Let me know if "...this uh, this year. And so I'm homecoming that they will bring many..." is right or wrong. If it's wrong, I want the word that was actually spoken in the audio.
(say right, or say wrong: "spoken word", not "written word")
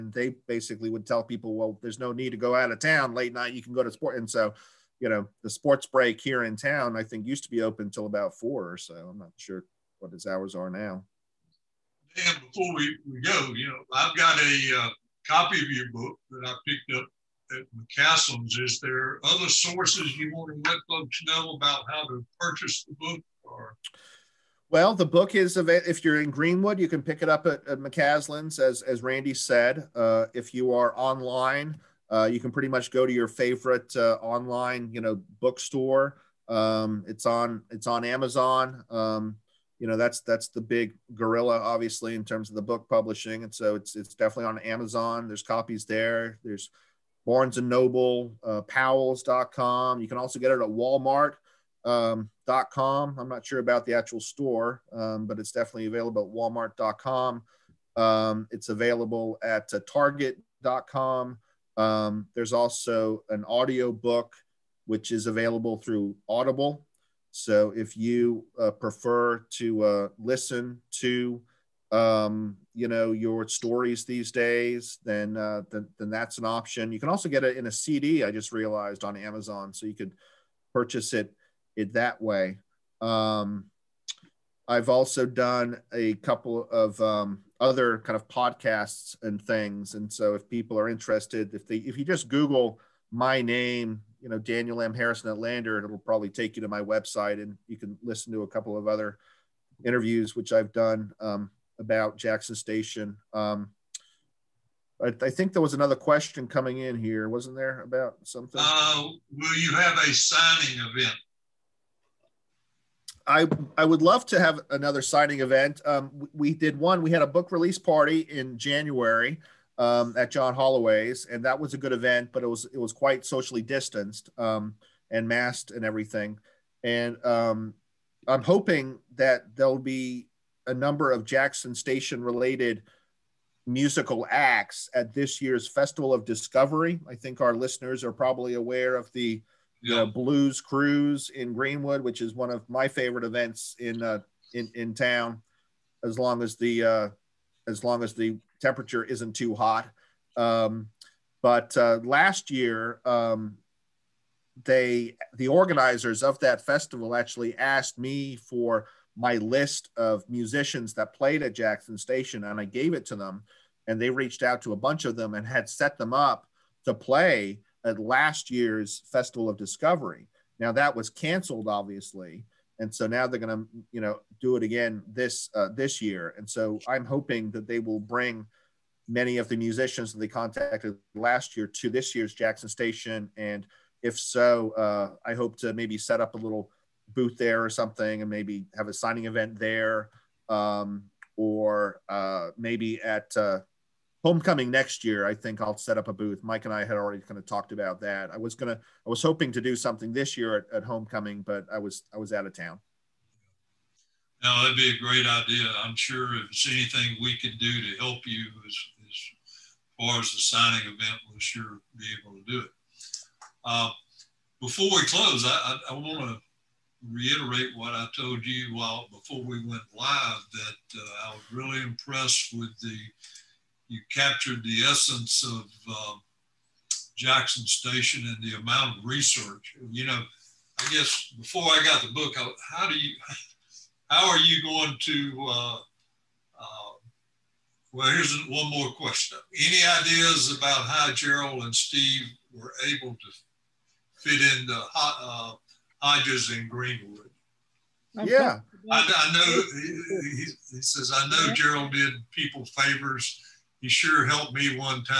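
wrong: "hoping", not "homecoming".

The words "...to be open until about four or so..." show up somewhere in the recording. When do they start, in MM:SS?
00:07.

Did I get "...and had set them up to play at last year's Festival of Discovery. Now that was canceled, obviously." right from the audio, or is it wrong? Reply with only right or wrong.
right.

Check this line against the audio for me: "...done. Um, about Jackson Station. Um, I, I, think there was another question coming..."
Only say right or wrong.
right.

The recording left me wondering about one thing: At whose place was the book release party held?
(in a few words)
John Holloway's.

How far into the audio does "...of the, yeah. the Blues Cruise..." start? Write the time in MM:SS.
02:18.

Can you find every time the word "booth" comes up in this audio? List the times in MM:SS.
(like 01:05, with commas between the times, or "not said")
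03:07, 03:16.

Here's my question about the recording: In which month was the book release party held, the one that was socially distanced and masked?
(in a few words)
January.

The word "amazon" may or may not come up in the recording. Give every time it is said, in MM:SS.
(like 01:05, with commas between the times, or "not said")
00:38, 00:44, 01:19.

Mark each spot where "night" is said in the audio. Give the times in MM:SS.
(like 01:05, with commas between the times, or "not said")
00:03.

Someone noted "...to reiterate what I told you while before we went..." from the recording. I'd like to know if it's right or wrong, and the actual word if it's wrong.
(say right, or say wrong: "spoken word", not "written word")
right.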